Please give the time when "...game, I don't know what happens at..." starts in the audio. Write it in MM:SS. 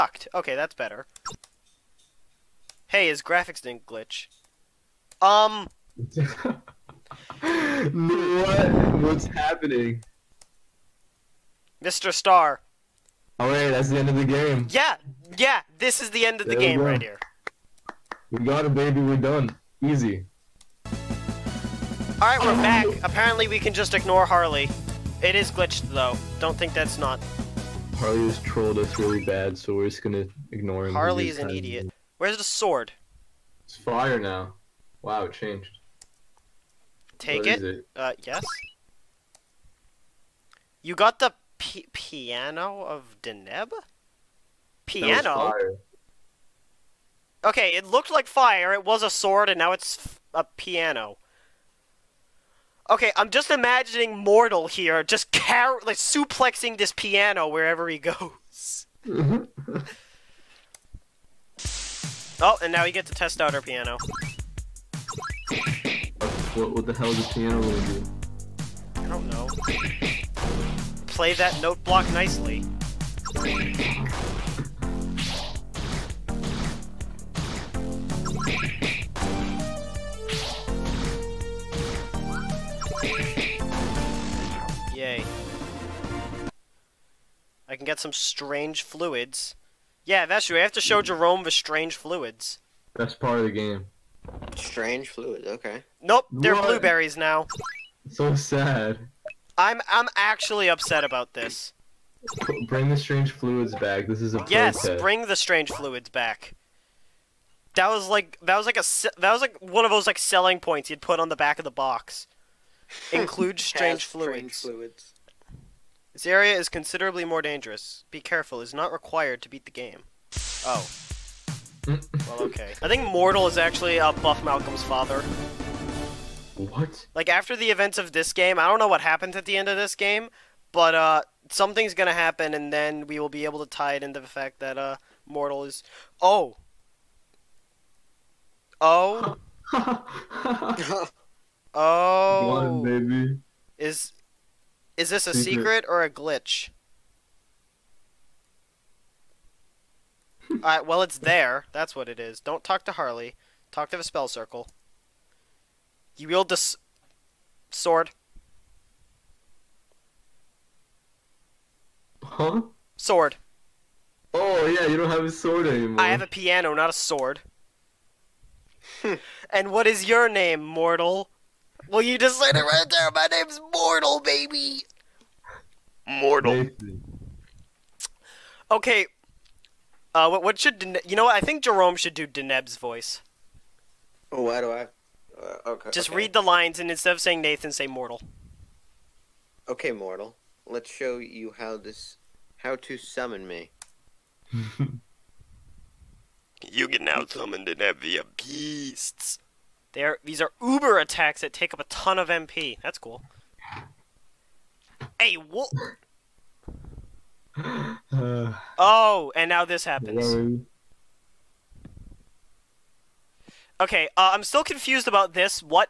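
02:08.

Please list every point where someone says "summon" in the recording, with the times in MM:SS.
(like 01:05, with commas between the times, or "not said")
03:12, 03:17.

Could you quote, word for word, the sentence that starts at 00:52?
Okay, I'm just imagining Mortal here just car like suplexing this piano wherever he goes.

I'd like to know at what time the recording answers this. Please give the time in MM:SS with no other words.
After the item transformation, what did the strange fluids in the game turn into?
01:36.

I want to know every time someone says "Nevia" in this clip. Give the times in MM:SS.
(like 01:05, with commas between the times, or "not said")
03:17.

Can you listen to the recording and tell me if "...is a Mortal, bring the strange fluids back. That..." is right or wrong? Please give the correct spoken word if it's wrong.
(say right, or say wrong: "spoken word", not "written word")
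wrong: "Yes", not "Mortal".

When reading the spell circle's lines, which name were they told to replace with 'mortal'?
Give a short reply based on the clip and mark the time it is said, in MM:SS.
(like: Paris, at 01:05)
Nathan, at 03:07.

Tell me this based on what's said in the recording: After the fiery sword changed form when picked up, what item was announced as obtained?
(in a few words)
Piano of Deneb.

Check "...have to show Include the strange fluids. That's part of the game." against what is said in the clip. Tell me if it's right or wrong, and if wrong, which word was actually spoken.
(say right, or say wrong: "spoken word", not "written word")
wrong: "Jerome", not "Include".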